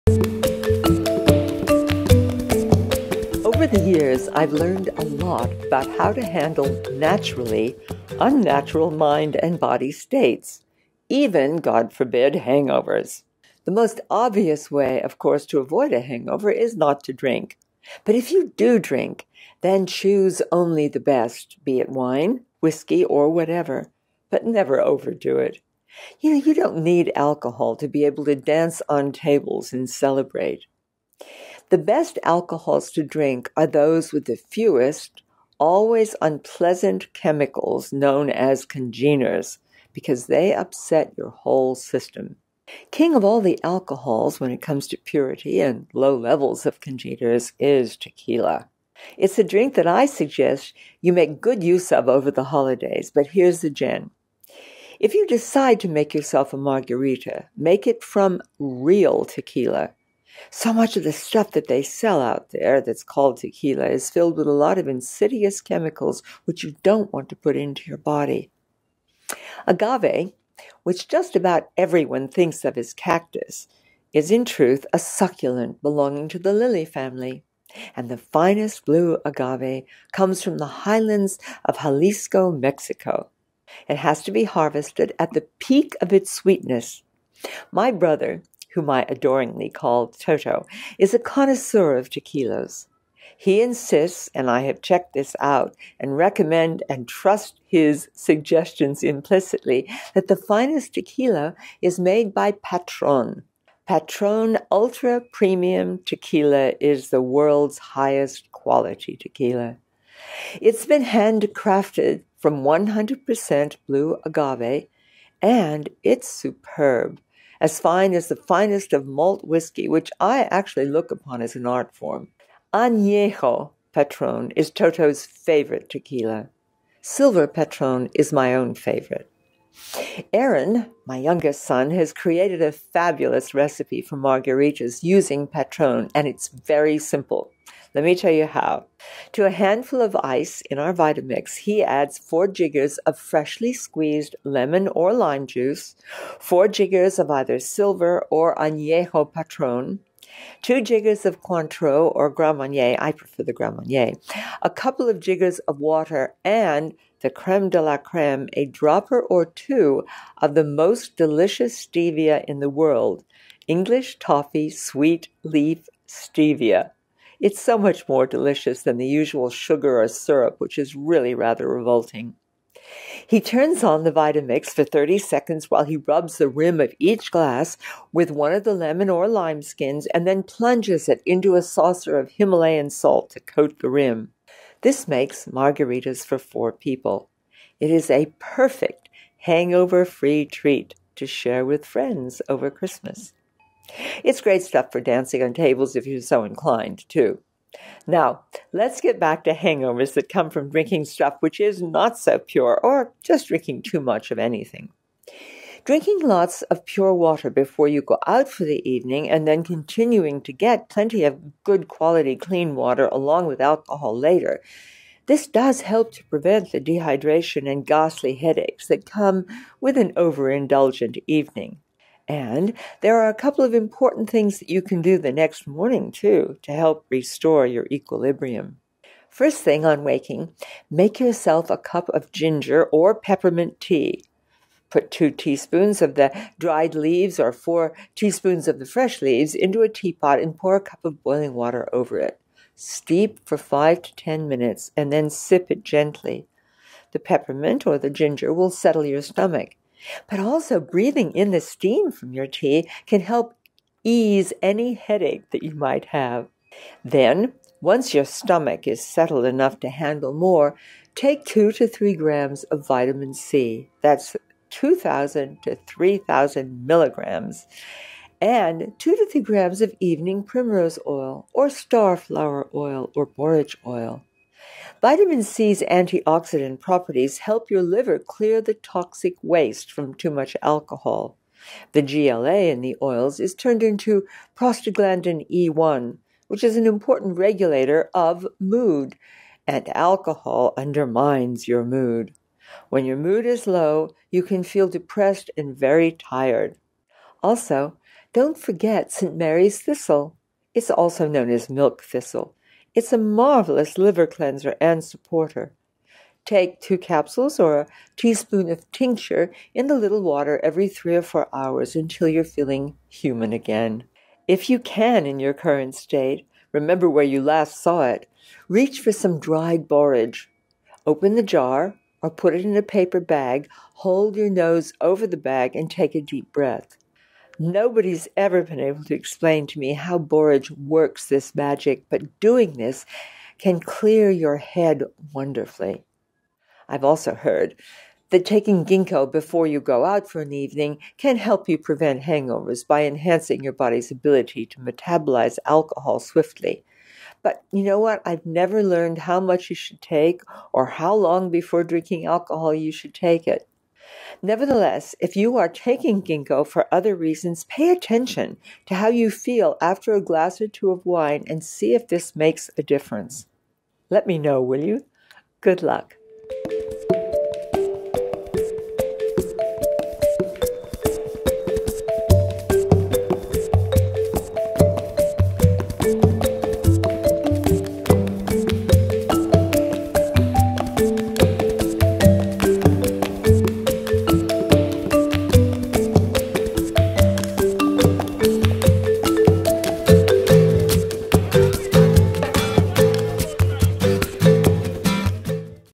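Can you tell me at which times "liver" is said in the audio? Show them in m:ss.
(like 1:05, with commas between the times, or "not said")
4:37, 5:03.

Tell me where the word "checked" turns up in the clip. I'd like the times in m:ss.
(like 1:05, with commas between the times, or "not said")
1:34.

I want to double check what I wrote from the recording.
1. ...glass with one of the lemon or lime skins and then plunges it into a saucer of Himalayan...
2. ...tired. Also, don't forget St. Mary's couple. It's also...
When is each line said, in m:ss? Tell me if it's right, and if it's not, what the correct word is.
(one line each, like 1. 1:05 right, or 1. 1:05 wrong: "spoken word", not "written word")
1. 2:57 right
2. 4:56 wrong: "thistle", not "couple".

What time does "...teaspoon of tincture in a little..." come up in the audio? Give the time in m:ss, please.
5:08.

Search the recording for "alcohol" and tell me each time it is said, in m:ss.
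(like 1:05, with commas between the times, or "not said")
0:27, 0:32, 0:43, 3:33, 4:40, 4:49, 5:45, 5:52.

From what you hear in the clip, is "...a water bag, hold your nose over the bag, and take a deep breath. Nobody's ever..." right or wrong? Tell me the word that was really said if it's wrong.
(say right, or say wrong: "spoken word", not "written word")
wrong: "paper", not "water".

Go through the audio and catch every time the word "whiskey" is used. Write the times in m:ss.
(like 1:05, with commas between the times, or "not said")
0:22, 1:59.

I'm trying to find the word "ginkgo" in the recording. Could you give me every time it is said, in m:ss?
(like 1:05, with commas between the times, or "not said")
5:38, 5:56.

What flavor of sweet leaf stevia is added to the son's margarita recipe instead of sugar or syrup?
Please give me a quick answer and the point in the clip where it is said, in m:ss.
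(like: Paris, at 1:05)
English toffee, at 2:43.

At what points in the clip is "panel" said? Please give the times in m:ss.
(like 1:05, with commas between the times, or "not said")
not said.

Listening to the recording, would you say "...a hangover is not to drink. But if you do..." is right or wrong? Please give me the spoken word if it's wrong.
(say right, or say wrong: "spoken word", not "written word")
right.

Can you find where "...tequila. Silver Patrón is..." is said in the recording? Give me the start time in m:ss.
2:05.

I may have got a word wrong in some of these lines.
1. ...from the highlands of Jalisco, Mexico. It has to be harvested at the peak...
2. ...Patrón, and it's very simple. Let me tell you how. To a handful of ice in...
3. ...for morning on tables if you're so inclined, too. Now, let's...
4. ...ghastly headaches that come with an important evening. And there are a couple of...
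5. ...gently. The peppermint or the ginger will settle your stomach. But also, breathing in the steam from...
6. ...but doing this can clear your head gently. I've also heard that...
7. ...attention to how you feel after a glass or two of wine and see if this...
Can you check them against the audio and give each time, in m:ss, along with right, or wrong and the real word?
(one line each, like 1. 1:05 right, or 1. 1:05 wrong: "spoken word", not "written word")
1. 1:20 right
2. 2:15 right
3. 3:14 wrong: "dancing", not "morning"
4. 3:37 wrong: "overindulgent", not "important"
5. 4:05 right
6. 5:32 wrong: "wonderfully", not "gently"
7. 5:57 right.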